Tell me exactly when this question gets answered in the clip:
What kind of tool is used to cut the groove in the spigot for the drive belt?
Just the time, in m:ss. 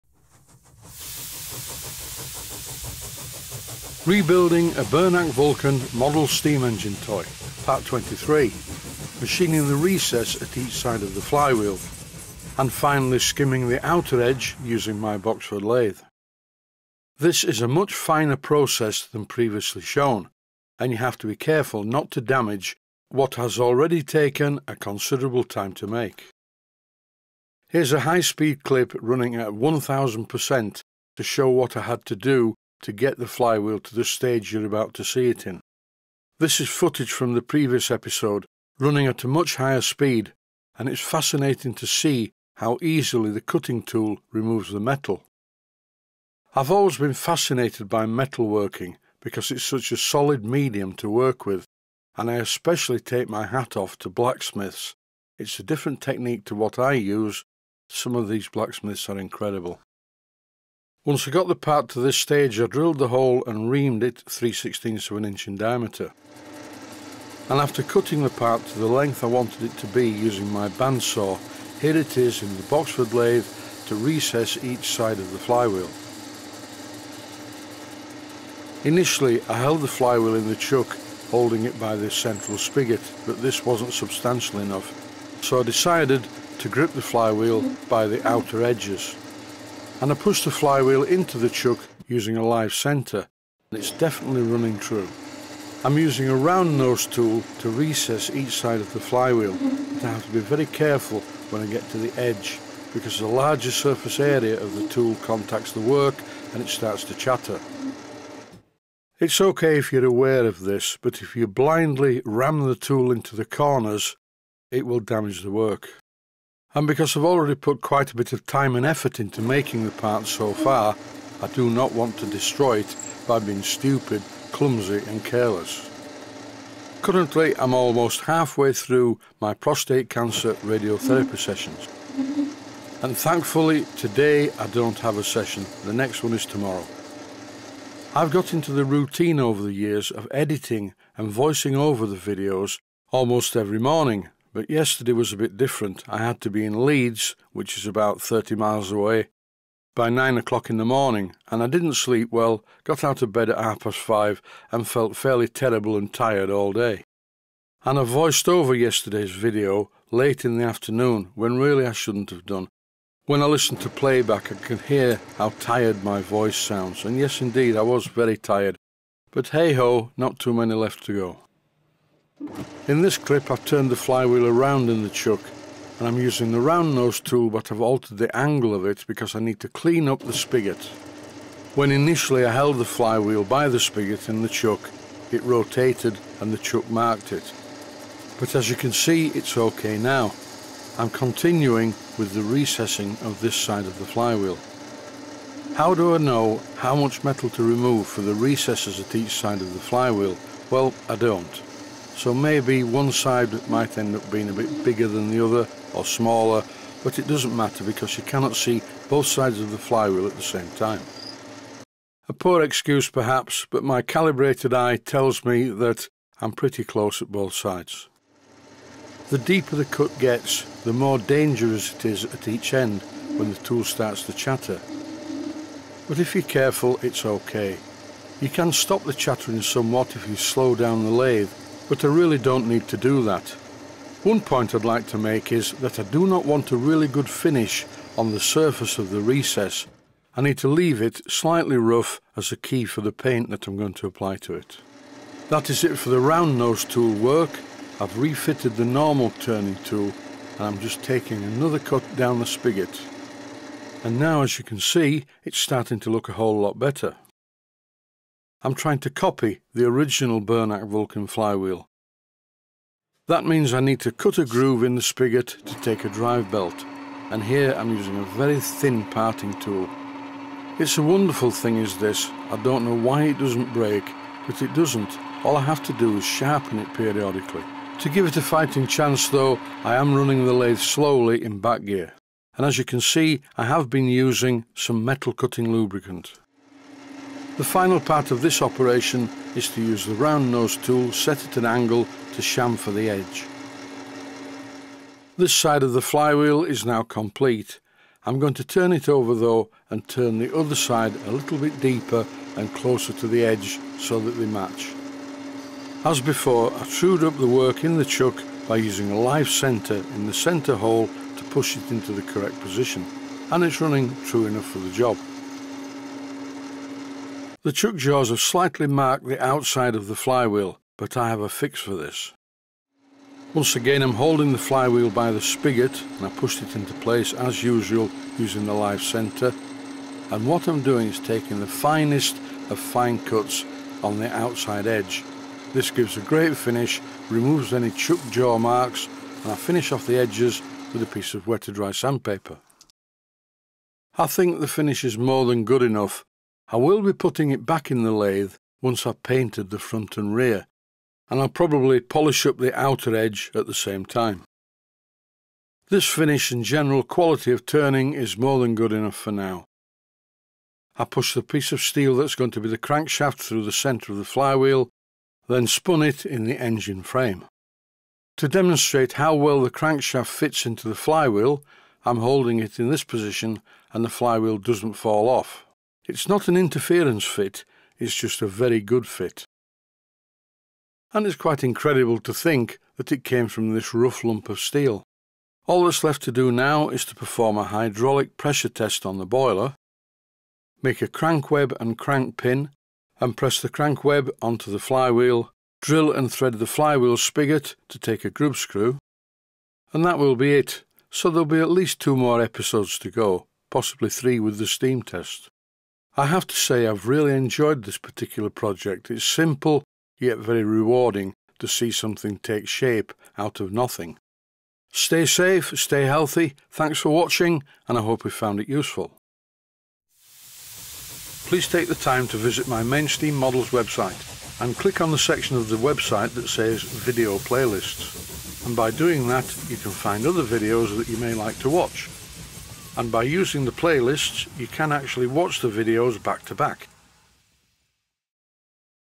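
4:28.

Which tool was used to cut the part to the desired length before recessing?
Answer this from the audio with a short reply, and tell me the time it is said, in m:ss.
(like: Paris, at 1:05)
bandsaw, at 1:10.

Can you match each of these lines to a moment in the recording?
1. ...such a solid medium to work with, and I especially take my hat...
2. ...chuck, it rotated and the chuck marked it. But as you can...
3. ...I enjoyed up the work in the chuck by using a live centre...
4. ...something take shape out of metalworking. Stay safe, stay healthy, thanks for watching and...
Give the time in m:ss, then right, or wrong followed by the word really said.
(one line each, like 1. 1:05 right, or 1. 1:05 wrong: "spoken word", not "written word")
1. 0:49 right
2. 3:04 right
3. 5:06 wrong: "trued", not "enjoyed"
4. 6:51 wrong: "nothing", not "metalworking".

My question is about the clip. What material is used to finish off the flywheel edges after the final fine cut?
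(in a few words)
wet to dry sandpaper.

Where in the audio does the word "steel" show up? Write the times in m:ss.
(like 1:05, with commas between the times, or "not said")
6:01, 6:24.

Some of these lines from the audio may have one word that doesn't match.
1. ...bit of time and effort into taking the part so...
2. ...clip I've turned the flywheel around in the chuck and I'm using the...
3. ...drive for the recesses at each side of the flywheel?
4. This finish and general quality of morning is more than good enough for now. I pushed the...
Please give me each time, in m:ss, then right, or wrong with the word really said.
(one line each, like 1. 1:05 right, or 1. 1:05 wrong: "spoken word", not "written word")
1. 1:58 wrong: "making", not "taking"
2. 2:53 right
3. 3:17 wrong: "remove", not "drive"
4. 5:55 wrong: "turning", not "morning".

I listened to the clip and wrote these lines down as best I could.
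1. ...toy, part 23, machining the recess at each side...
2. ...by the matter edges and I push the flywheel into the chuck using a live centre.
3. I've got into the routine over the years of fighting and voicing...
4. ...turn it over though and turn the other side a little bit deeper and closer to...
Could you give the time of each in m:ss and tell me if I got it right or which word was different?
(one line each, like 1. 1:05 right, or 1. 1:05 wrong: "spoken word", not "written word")
1. 0:07 right
2. 1:27 wrong: "outer", not "matter"
3. 2:18 wrong: "editing", not "fighting"
4. 4:58 right.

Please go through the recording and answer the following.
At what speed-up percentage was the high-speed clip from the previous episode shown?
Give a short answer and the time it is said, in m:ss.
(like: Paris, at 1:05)
1000%, at 0:29.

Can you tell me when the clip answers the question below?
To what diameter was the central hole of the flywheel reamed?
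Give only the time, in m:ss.
1:04.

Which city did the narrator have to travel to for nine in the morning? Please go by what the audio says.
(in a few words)
Leeds.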